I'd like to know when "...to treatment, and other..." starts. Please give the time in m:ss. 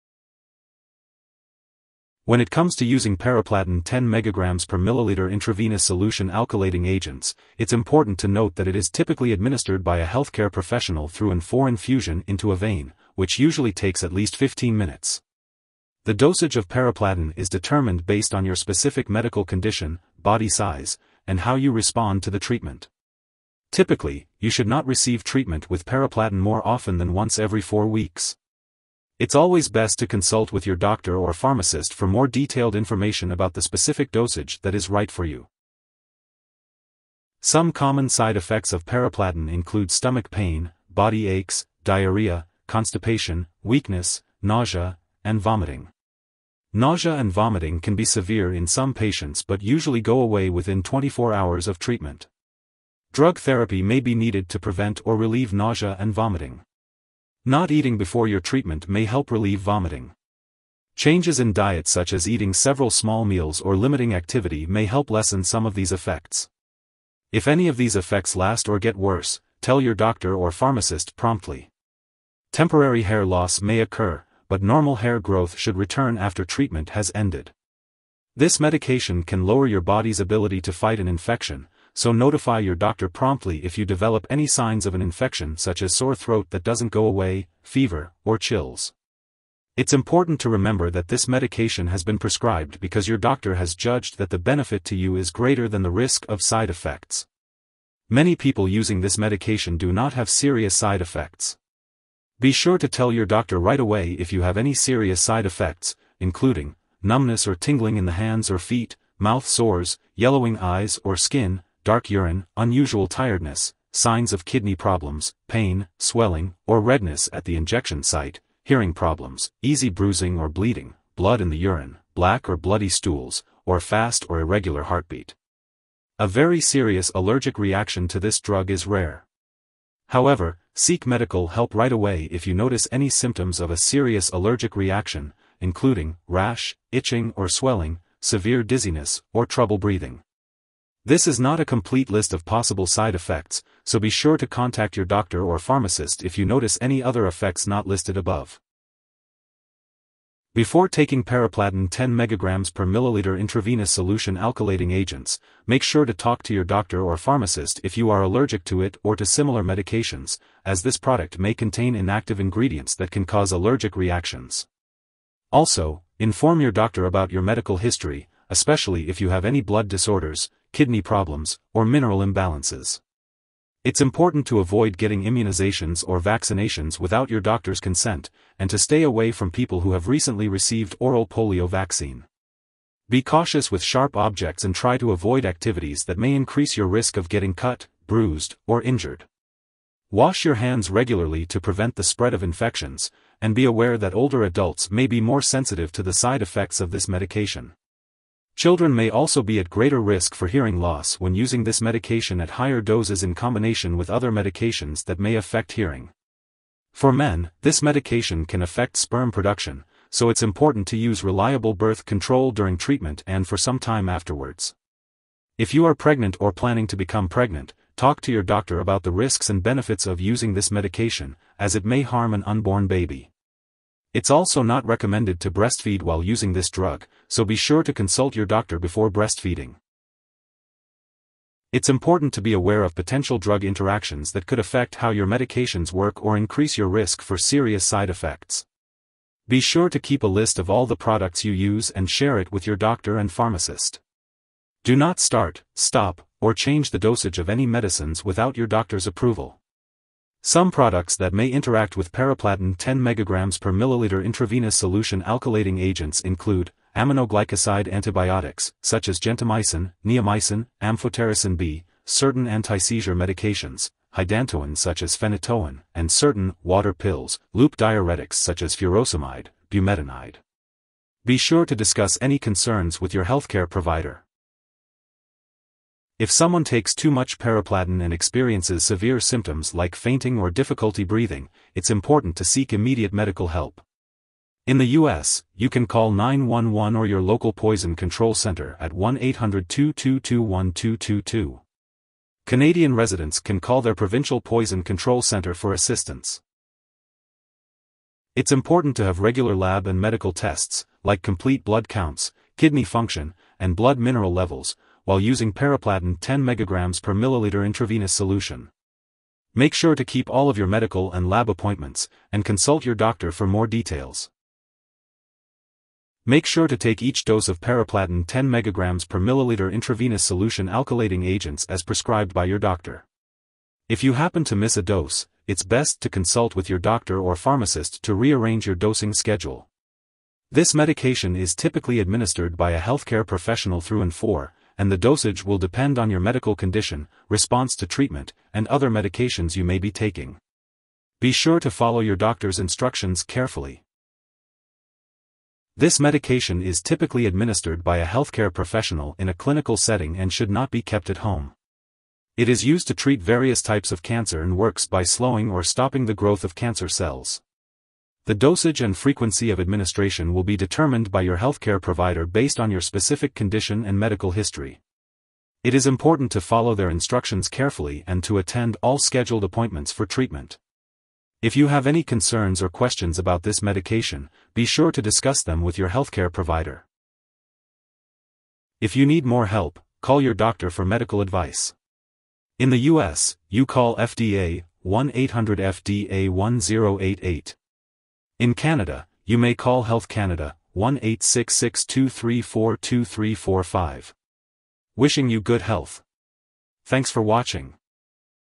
5:37.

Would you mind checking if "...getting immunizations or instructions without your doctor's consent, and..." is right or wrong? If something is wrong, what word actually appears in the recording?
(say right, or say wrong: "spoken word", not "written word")
wrong: "vaccinations", not "instructions".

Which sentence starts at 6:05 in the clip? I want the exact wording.
It is important to follow their instructions carefully and to attend all scheduled appointments for treatment.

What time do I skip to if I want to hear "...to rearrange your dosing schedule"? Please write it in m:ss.
5:28.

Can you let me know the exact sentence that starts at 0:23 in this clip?
Typically, you should not receive treatment with paraplatin more often than once every 4 weeks.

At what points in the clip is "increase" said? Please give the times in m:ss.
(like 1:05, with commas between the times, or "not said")
3:06, 3:56.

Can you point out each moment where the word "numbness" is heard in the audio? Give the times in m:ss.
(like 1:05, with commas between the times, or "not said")
1:47.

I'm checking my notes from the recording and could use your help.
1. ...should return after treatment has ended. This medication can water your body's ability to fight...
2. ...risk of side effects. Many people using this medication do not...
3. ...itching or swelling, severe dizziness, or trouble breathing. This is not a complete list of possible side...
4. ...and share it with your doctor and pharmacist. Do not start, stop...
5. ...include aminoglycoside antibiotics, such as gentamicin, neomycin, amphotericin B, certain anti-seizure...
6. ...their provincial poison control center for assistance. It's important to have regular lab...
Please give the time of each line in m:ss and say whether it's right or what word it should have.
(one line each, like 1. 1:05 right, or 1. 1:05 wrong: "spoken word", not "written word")
1. 1:15 wrong: "lower", not "water"
2. 1:35 right
3. 2:16 right
4. 4:01 right
5. 4:16 right
6. 4:53 right.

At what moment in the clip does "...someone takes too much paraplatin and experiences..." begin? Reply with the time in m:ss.
4:36.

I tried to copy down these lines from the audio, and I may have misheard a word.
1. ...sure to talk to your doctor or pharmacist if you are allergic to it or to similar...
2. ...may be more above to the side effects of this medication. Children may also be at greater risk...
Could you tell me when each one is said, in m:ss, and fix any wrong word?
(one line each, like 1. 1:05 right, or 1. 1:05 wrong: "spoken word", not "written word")
1. 2:35 right
2. 3:14 wrong: "sensitive", not "above".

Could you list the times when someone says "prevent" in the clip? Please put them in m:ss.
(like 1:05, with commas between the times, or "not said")
0:54, 3:11.